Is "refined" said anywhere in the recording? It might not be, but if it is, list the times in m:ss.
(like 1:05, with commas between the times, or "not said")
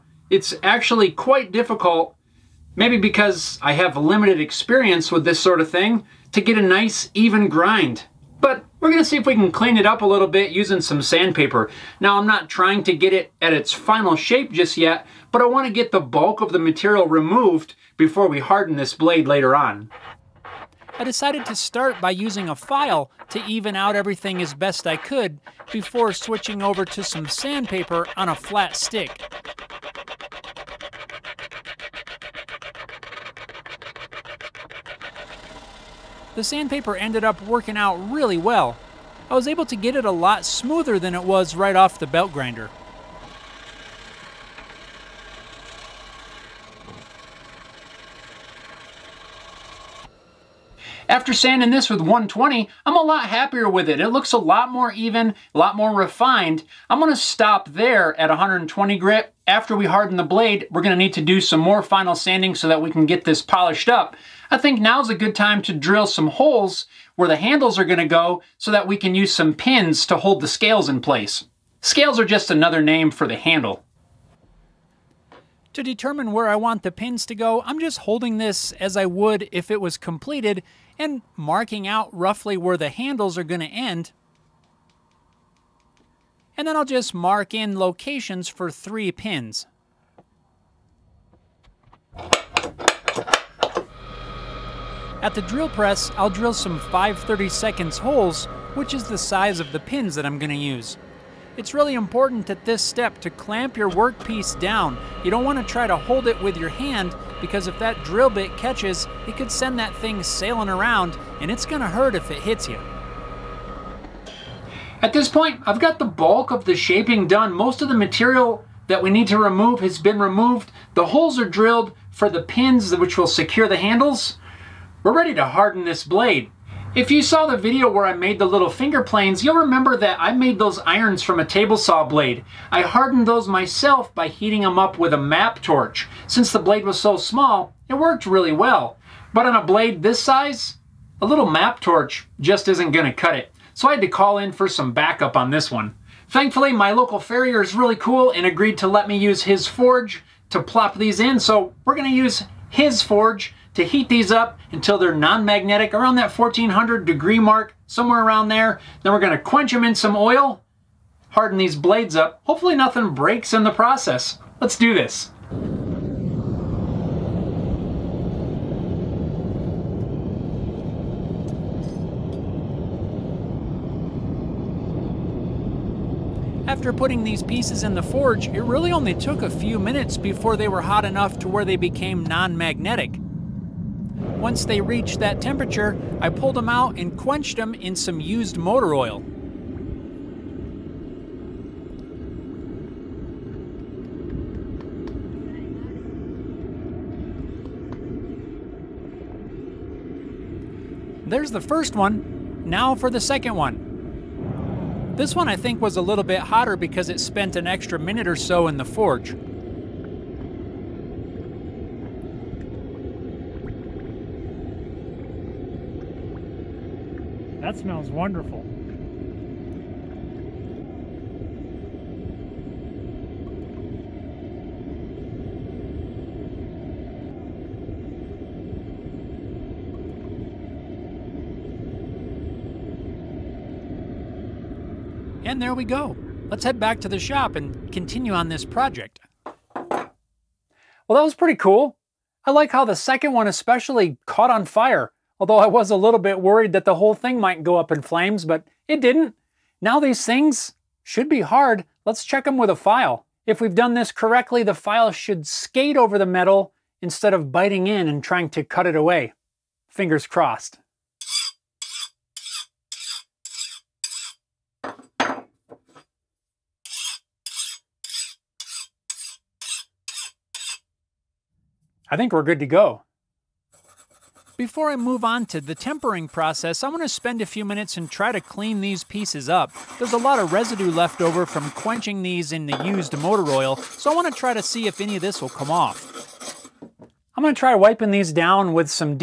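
0:55.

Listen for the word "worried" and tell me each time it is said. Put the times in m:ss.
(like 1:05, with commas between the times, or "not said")
4:06.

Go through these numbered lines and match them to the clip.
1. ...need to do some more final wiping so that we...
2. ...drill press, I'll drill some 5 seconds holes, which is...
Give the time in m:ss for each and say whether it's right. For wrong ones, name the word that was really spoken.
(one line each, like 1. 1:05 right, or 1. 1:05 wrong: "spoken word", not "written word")
1. 1:00 wrong: "sanding", not "wiping"
2. 1:35 right.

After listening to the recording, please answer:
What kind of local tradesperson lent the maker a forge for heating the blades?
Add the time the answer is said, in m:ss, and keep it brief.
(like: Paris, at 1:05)
Farrier, at 2:27.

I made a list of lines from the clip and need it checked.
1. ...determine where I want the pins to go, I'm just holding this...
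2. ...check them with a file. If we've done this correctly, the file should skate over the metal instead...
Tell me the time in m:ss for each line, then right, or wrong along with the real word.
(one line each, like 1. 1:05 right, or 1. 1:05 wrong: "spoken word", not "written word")
1. 1:15 right
2. 4:12 right.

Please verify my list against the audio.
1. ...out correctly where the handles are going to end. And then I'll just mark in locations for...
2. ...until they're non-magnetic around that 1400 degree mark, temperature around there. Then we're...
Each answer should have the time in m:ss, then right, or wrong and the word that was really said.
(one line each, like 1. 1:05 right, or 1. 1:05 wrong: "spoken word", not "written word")
1. 1:21 wrong: "roughly", not "correctly"
2. 2:34 wrong: "somewhere", not "temperature".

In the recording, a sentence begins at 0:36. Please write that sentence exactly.
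The sandpaper ended up working out really well.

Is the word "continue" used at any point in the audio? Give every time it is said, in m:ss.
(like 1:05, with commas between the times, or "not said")
3:57.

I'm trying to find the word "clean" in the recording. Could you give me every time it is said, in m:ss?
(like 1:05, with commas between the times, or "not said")
0:09, 4:38.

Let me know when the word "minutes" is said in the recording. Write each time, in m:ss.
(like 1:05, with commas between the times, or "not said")
2:59, 3:27, 4:37.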